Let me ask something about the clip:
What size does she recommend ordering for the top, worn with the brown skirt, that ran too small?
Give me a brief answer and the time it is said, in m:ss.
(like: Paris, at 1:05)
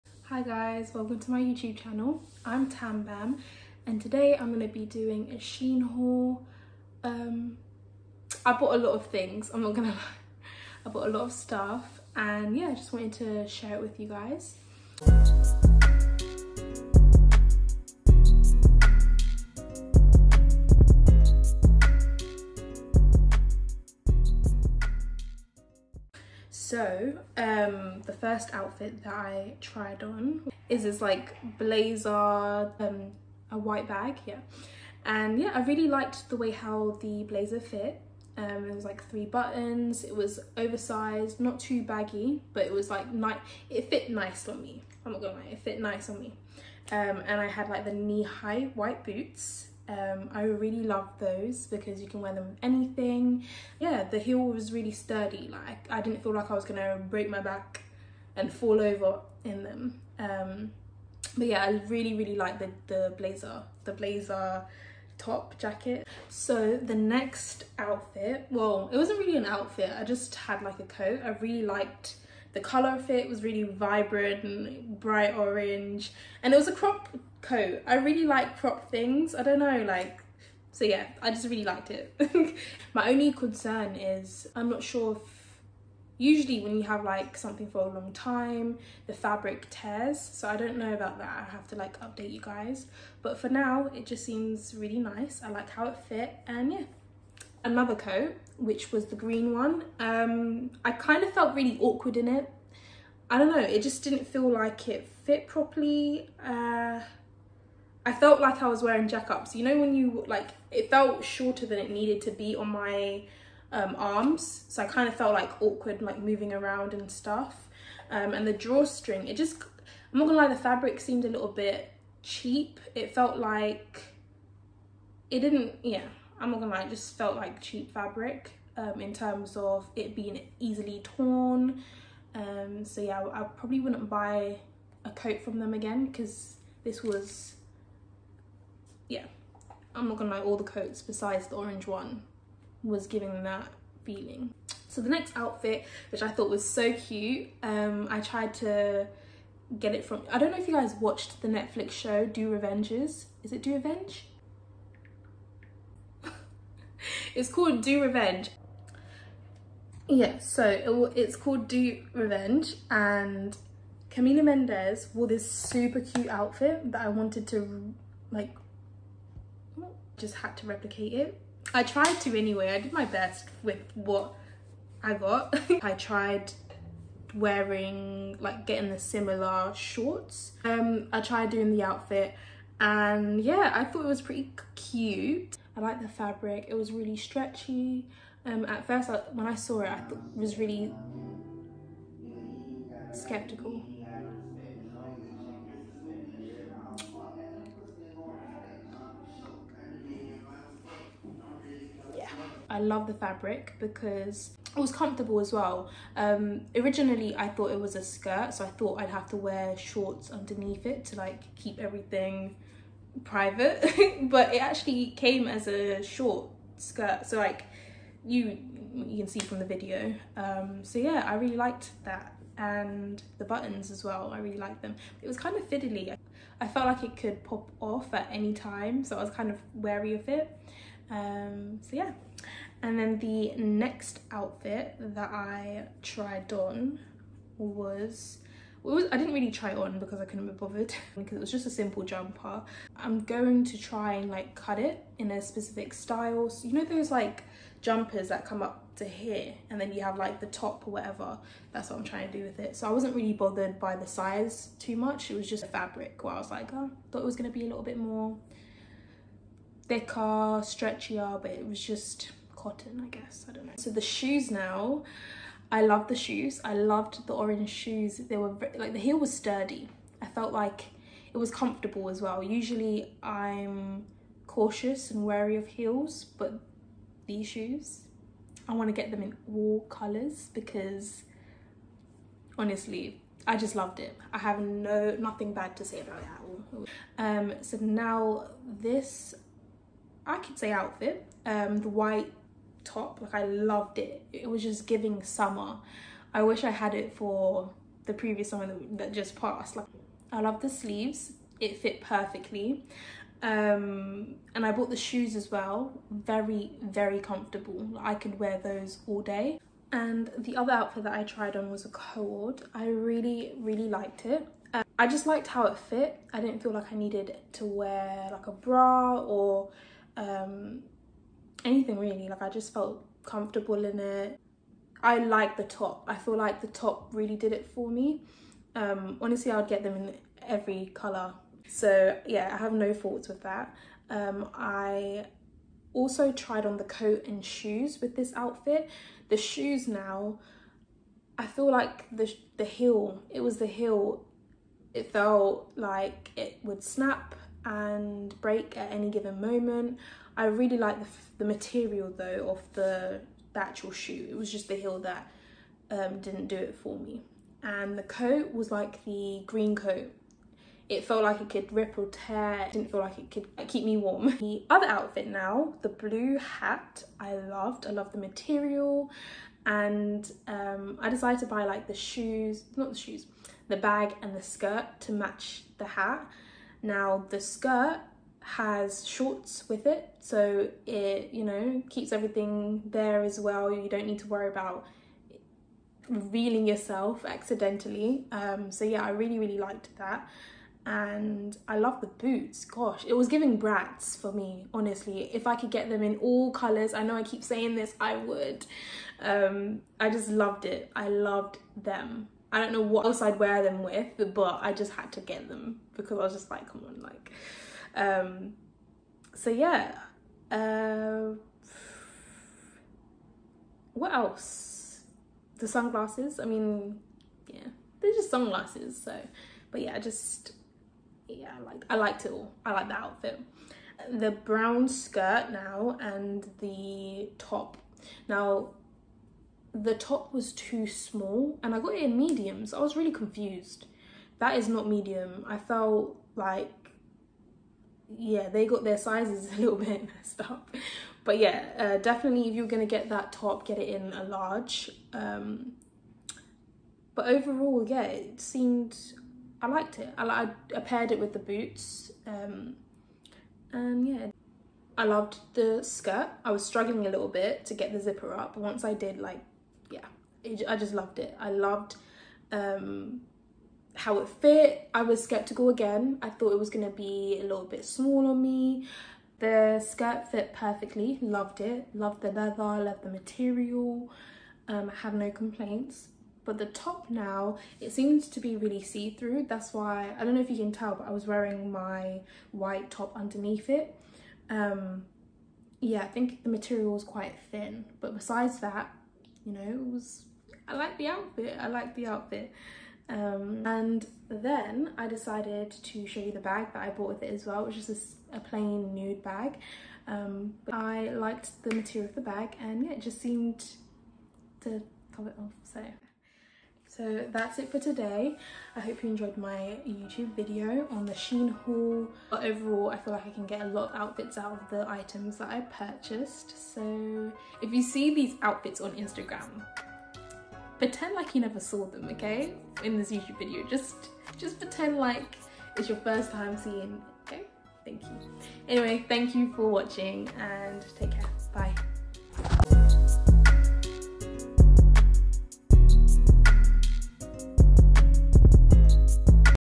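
Large, at 7:24.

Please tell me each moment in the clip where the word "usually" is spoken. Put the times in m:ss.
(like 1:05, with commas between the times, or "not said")
1:26, 4:32.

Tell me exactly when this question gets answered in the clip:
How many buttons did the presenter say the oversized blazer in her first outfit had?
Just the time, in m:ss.
0:39.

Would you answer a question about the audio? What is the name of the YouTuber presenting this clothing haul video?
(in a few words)
TamBam.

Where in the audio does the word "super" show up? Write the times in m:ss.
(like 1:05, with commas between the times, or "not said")
2:45.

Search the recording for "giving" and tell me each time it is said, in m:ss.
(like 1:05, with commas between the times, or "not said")
2:23, 4:54, 6:33.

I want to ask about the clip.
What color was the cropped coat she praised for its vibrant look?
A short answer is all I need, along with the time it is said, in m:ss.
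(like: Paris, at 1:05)
Bright orange, at 1:14.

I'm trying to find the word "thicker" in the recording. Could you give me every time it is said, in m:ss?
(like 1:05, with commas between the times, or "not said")
4:19.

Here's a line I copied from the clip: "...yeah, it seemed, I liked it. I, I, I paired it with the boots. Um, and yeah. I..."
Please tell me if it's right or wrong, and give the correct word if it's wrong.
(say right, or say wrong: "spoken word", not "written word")
right.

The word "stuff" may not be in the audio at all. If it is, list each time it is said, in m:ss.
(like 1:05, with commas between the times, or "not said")
0:11, 1:57.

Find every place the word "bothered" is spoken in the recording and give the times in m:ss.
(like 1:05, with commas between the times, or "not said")
4:00, 4:13.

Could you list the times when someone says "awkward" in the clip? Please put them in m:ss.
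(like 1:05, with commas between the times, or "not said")
1:41, 1:55.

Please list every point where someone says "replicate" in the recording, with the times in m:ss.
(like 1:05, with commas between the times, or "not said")
2:50.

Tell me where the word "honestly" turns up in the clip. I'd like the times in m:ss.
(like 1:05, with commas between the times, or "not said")
4:42, 5:29, 6:34.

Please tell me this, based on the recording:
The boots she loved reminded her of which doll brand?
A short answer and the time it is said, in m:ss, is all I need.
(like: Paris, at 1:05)
Bratz, at 6:33.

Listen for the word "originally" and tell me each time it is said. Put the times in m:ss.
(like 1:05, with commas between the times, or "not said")
3:26.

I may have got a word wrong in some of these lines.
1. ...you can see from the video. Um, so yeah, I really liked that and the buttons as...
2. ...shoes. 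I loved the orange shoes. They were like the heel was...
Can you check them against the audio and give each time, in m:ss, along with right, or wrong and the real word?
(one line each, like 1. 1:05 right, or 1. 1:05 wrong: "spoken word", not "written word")
1. 3:38 right
2. 4:26 right.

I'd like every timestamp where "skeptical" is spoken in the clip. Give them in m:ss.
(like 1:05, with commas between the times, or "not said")
3:13, 7:45.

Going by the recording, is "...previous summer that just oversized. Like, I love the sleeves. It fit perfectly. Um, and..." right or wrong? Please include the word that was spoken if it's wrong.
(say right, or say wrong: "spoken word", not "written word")
wrong: "passed", not "oversized".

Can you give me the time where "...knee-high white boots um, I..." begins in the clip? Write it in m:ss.
0:47.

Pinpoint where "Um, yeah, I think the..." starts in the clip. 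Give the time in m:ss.
8:04.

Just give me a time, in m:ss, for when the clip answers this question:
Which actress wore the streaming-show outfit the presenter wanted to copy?
2:44.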